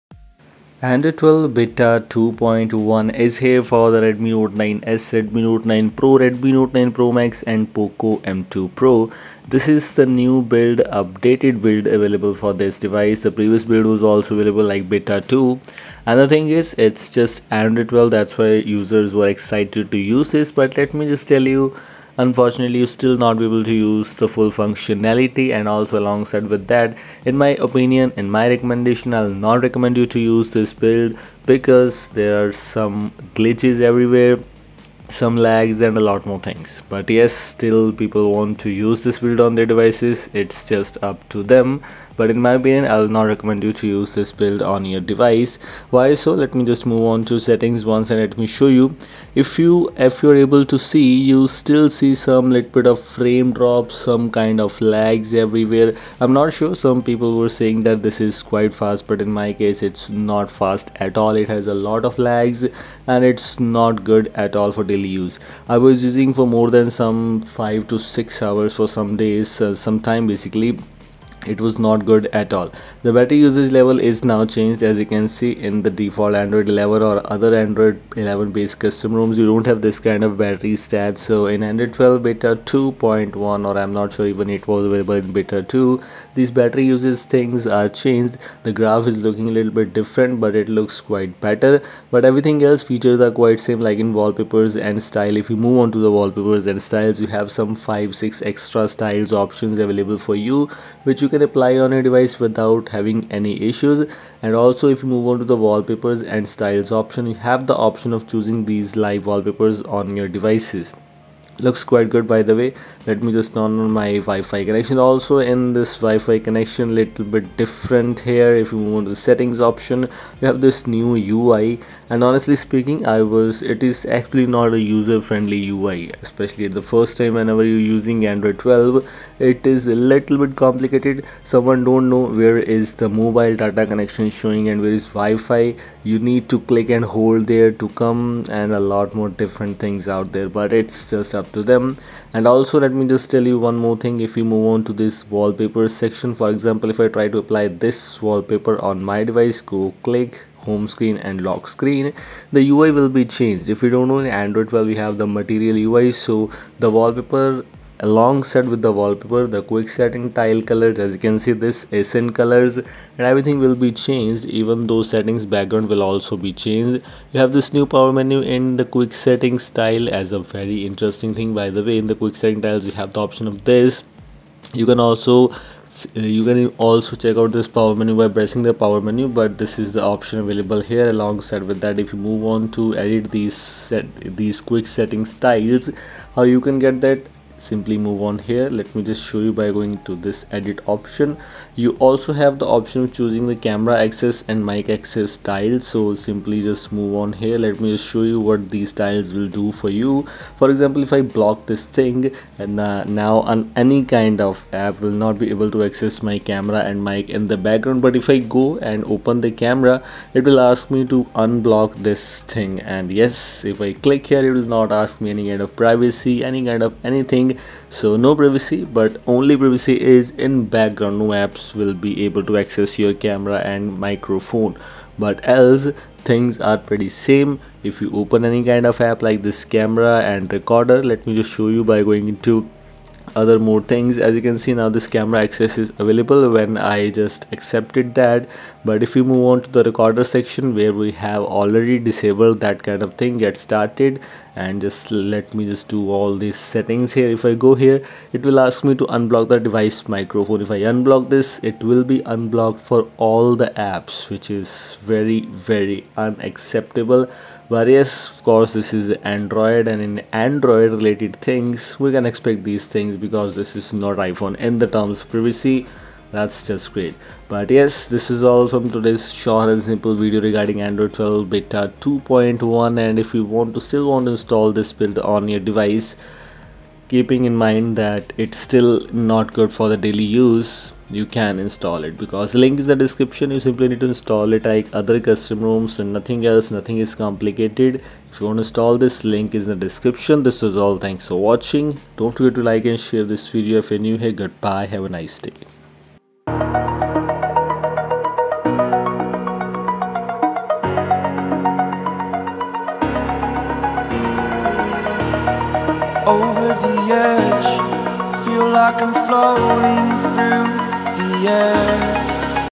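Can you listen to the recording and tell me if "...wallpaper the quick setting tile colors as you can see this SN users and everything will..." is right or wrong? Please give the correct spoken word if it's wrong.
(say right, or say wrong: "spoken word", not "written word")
wrong: "colors", not "users".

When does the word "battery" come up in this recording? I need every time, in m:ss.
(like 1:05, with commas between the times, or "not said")
1:13, 1:20, 1:26.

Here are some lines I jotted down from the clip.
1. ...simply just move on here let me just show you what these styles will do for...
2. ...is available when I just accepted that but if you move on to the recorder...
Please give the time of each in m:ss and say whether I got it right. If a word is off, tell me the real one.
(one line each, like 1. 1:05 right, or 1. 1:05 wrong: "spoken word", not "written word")
1. 3:16 wrong: "tiles", not "styles"
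2. 3:55 right.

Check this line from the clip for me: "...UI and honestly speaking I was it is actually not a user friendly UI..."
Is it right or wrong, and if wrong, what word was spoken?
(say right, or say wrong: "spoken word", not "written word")
right.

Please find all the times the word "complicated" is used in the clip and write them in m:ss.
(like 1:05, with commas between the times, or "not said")
2:10, 4:47.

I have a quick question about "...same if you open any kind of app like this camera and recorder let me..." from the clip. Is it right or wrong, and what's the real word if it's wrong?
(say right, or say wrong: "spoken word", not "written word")
right.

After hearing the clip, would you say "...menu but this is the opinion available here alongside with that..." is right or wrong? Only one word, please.
wrong.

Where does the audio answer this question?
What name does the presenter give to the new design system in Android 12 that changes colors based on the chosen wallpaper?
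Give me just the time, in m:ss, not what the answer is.
2:35.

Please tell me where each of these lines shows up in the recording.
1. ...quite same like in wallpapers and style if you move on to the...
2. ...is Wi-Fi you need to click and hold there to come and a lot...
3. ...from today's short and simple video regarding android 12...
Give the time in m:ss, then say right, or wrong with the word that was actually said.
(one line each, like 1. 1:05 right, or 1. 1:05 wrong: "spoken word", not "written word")
1. 1:33 right
2. 2:14 right
3. 4:28 right.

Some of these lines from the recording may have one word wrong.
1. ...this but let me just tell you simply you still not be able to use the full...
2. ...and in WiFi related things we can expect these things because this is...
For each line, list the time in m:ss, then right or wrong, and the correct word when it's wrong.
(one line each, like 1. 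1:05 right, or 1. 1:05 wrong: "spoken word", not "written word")
1. 0:20 wrong: "unfortunately", not "simply"
2. 4:19 wrong: "Android", not "WiFi".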